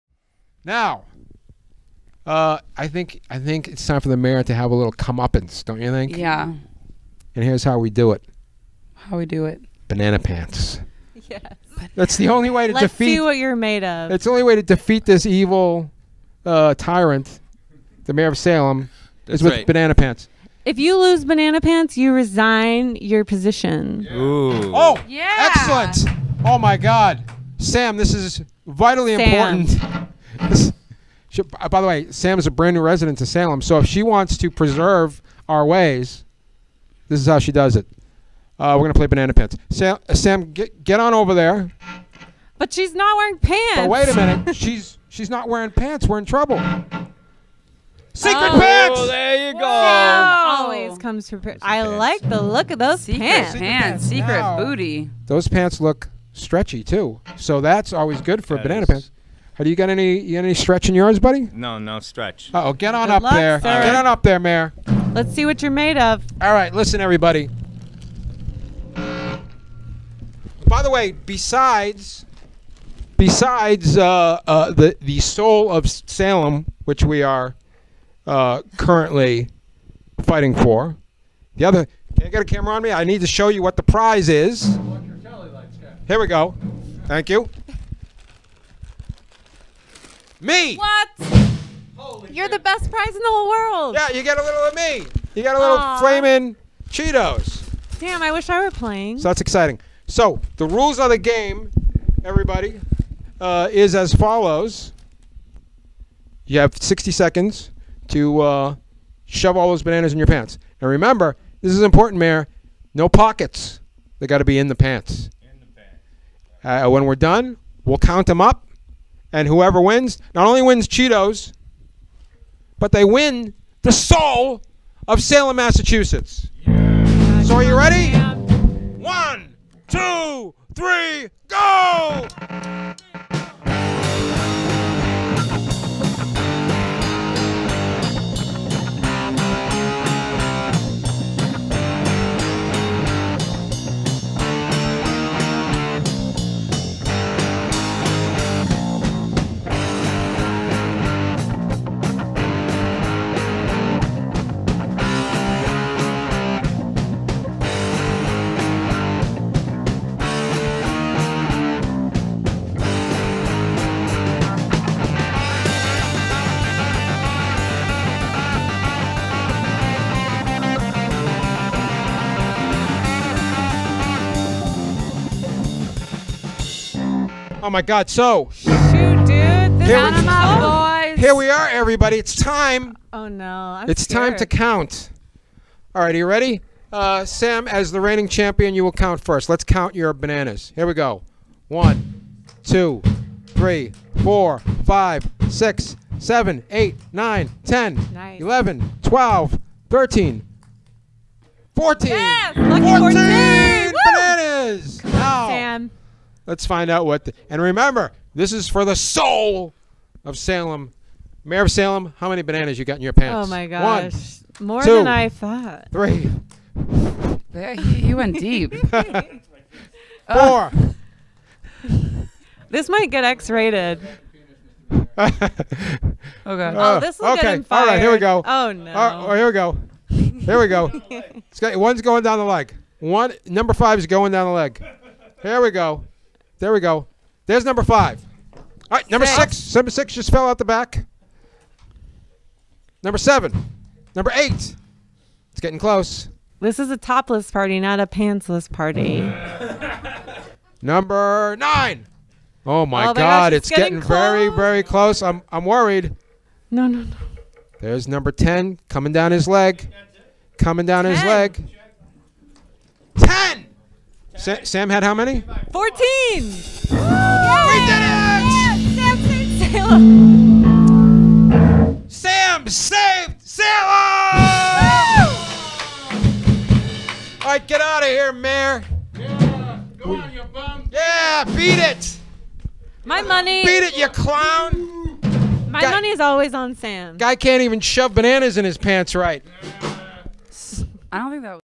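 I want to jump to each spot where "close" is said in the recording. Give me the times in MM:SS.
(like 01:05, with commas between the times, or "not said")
04:05, 04:14.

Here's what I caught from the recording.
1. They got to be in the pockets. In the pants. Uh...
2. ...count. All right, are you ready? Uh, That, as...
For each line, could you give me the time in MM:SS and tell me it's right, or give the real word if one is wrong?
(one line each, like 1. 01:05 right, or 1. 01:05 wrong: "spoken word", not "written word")
1. 01:54 wrong: "pants", not "pockets"
2. 03:04 wrong: "Sam", not "That".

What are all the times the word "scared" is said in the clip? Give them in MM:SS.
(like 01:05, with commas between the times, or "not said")
03:04.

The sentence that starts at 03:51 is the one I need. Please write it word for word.
it's got, one's going down the leg.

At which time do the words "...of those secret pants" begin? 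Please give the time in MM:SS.
00:52.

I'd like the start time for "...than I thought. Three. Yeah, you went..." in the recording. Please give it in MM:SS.
03:34.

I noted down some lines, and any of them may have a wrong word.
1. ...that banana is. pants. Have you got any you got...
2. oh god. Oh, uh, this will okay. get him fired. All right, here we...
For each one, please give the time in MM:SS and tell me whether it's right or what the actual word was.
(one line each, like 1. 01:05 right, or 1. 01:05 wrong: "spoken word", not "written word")
1. 00:58 right
2. 03:44 right.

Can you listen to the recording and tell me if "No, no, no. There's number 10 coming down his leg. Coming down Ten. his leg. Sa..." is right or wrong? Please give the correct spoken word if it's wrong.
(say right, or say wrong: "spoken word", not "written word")
right.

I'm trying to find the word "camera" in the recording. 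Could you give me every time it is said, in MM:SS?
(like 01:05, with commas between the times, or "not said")
01:22.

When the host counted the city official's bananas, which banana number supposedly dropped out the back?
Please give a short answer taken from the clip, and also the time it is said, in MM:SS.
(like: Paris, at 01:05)
6, at 03:59.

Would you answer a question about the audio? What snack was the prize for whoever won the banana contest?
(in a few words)
Flaming Cheetos.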